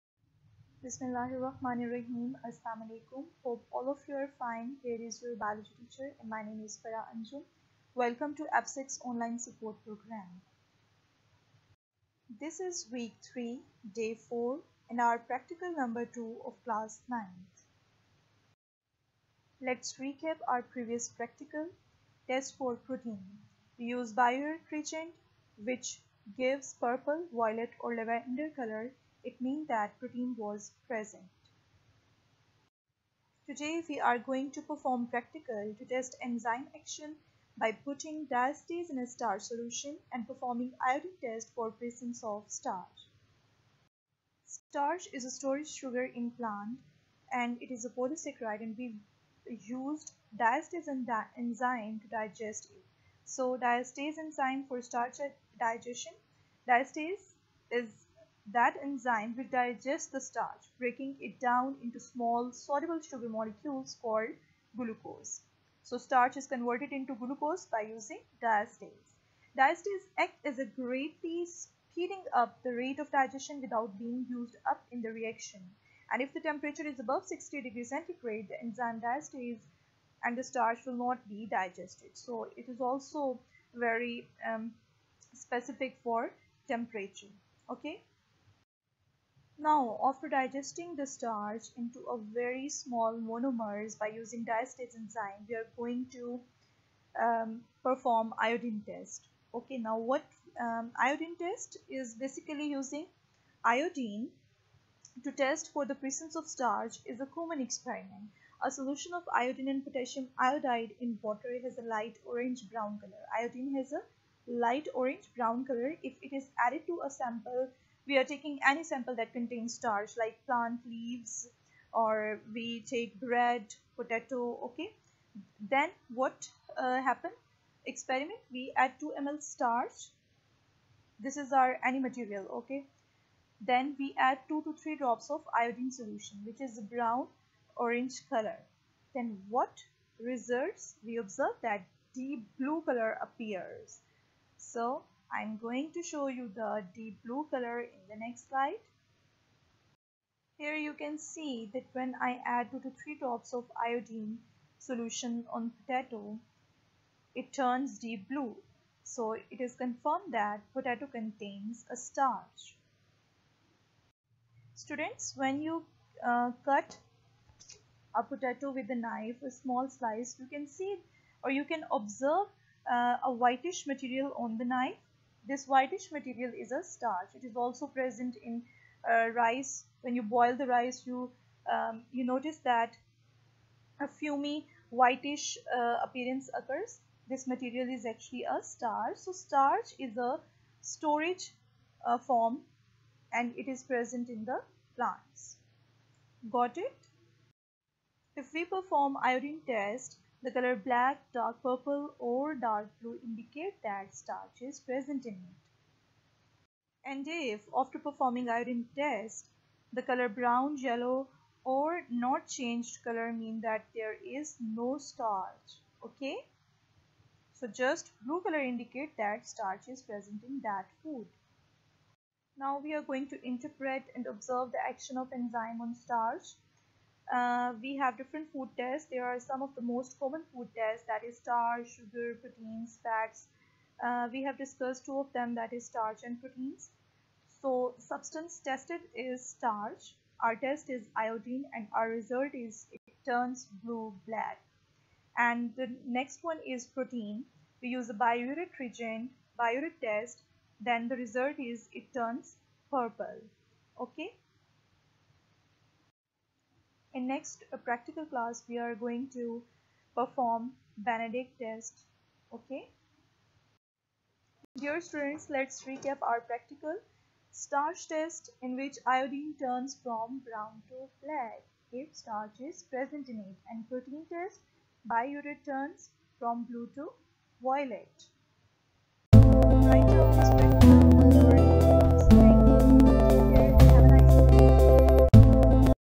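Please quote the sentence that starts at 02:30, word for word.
Here you can see that when I add 2 to 3 drops of iodine solution on potato, it turns deep blue.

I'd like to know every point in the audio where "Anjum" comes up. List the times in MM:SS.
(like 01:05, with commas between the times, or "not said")
00:07.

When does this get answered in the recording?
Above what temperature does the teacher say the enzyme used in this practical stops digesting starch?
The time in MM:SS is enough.
01:17.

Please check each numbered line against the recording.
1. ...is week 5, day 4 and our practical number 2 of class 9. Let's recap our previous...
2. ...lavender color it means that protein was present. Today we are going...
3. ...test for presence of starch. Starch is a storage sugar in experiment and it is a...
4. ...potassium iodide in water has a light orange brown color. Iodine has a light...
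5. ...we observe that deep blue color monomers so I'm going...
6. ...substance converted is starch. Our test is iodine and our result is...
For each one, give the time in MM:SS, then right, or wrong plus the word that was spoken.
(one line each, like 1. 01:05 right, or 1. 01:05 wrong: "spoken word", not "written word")
1. 00:12 wrong: "3", not "5"
2. 00:27 right
3. 00:41 wrong: "plant", not "experiment"
4. 01:49 right
5. 02:21 wrong: "appears", not "monomers"
6. 03:57 wrong: "tested", not "converted".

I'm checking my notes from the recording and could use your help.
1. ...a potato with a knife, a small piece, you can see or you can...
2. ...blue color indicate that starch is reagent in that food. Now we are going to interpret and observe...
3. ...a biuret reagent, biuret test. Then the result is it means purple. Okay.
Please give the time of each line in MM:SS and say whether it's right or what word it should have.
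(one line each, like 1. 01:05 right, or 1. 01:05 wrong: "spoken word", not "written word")
1. 02:48 wrong: "slice", not "piece"
2. 03:38 wrong: "present", not "reagent"
3. 04:08 wrong: "turns", not "means".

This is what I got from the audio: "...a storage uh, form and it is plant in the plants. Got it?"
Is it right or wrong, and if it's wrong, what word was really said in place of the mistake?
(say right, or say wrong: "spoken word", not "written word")
wrong: "present", not "plant".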